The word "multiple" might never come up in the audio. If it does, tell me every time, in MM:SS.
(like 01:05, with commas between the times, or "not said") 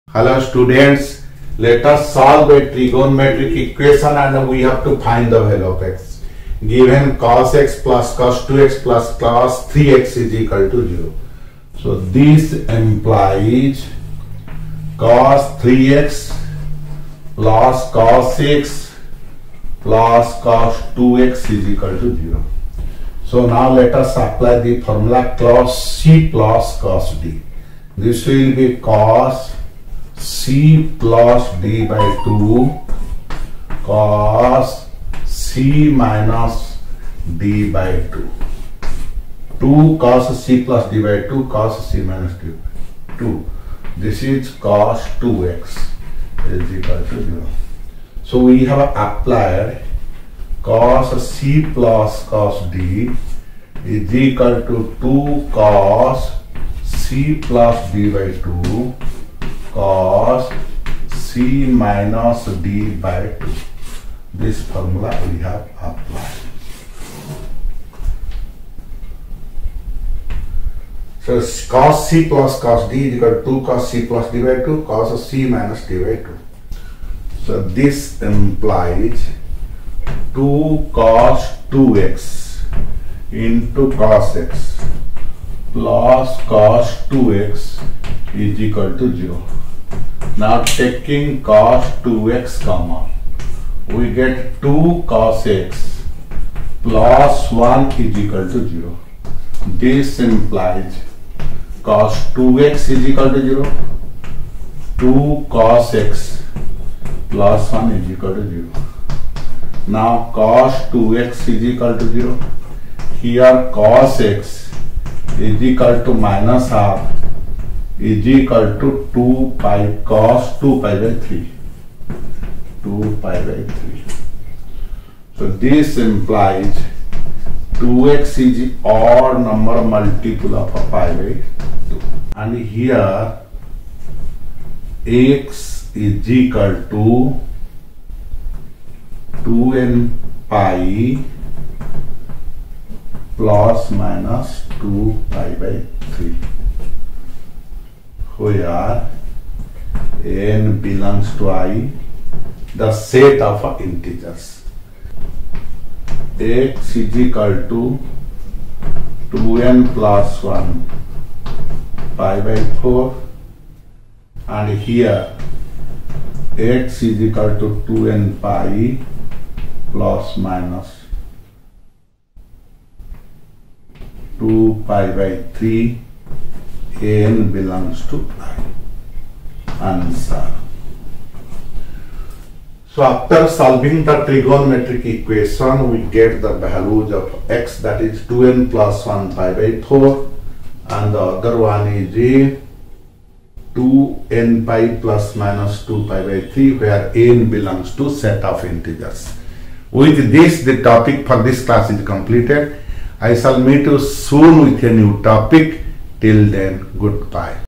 02:09.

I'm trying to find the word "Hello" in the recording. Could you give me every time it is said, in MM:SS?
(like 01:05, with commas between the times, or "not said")
00:00.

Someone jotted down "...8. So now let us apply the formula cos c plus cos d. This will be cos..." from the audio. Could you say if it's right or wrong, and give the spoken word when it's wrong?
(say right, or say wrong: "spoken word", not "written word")
wrong: "0", not "8".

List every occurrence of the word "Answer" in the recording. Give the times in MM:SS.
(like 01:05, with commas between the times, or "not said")
02:59.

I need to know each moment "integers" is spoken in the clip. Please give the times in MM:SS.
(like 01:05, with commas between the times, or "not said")
02:33, 03:18.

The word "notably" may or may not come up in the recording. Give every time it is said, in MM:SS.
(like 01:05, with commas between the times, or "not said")
not said.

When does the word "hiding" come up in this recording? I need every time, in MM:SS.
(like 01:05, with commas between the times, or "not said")
not said.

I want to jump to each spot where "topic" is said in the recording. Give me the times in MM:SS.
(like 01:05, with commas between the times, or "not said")
03:20, 03:25.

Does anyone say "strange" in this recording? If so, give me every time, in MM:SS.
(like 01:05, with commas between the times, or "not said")
not said.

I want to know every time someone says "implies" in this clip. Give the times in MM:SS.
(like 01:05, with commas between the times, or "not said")
00:12, 01:18, 01:40, 02:05.